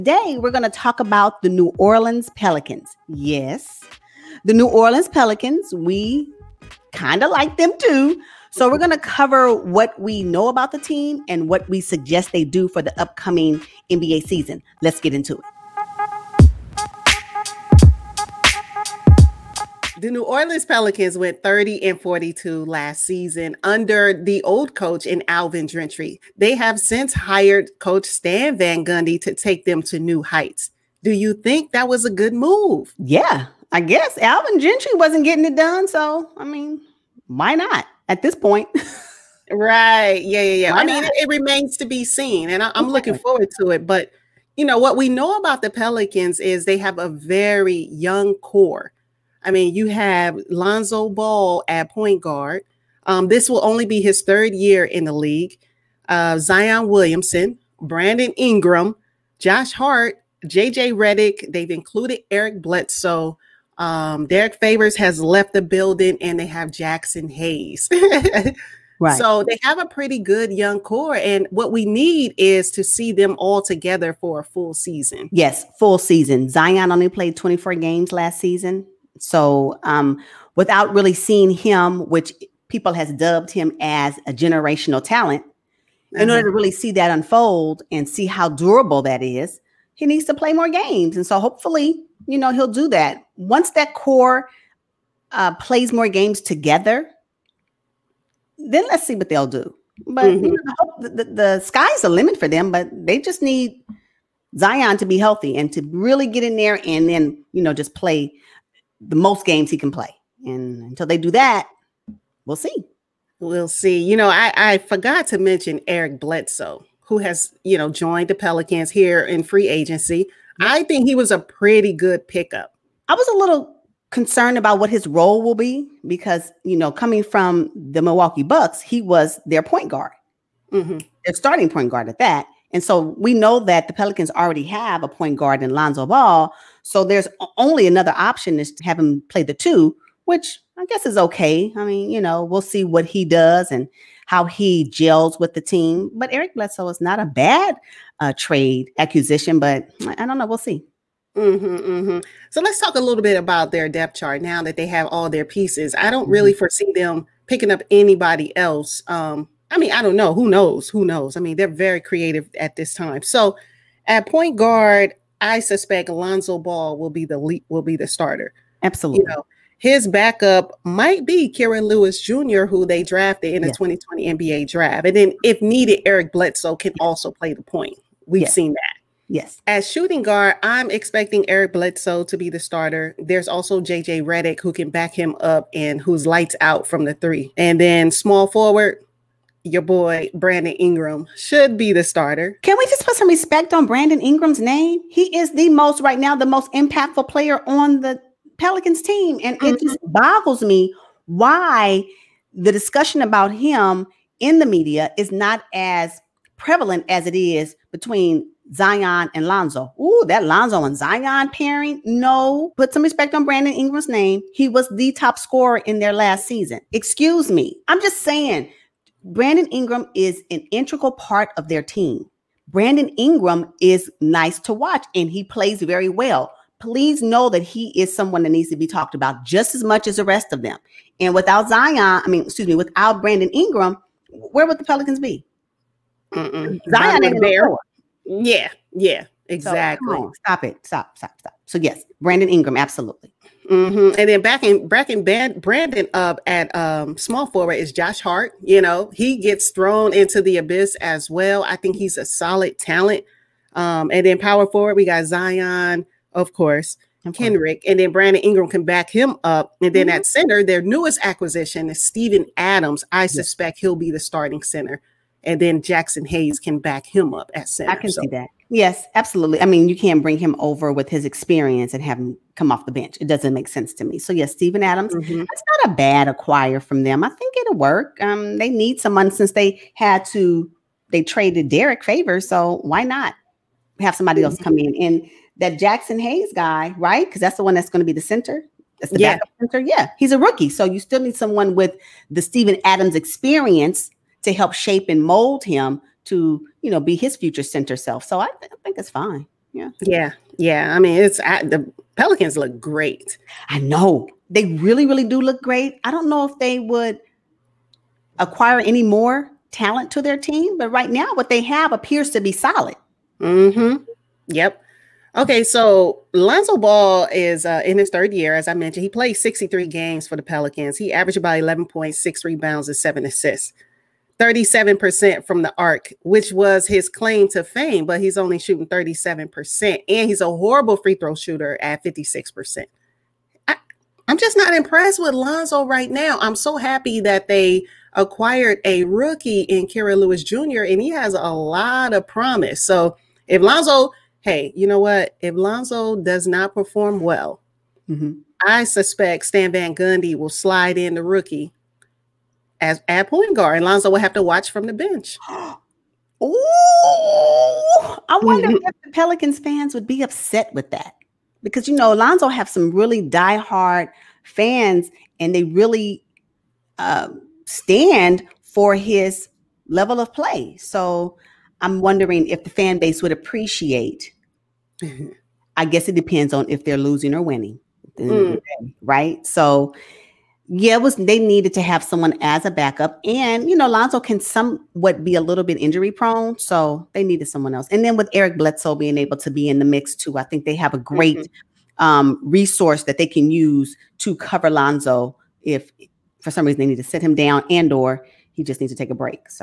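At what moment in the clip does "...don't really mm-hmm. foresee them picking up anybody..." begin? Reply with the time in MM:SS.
02:36.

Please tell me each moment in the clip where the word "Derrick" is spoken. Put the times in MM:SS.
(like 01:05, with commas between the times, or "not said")
01:04, 04:41.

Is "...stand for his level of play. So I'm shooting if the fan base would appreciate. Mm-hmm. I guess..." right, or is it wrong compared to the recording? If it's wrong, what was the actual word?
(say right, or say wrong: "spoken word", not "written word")
wrong: "wondering", not "shooting".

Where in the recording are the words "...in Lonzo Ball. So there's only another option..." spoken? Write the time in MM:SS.
02:15.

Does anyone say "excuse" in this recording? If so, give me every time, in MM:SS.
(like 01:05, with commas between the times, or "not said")
03:36, 03:52.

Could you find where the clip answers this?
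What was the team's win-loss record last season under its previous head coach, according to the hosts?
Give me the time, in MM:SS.
00:21.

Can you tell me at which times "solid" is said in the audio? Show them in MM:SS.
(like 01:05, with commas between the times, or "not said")
04:12, 05:12.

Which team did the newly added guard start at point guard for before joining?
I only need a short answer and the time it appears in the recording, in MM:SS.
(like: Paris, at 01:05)
Milwaukee Bucks, at 02:08.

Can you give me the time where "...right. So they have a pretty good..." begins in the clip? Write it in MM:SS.
01:08.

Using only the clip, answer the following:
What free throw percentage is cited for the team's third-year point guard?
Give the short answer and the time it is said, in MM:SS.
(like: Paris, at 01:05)
56%, at 05:32.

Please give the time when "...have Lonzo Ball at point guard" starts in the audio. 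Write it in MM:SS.
00:49.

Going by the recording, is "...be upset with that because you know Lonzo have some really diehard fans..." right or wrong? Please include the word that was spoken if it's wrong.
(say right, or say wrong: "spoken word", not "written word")
right.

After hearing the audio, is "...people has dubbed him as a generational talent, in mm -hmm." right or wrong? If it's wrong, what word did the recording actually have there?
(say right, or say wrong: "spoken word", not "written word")
right.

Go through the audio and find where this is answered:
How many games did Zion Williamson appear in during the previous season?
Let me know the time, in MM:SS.
01:17.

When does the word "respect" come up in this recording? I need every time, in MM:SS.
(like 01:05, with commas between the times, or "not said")
03:13, 03:33.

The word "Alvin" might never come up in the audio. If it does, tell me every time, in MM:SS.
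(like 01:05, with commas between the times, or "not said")
00:25, 00:34.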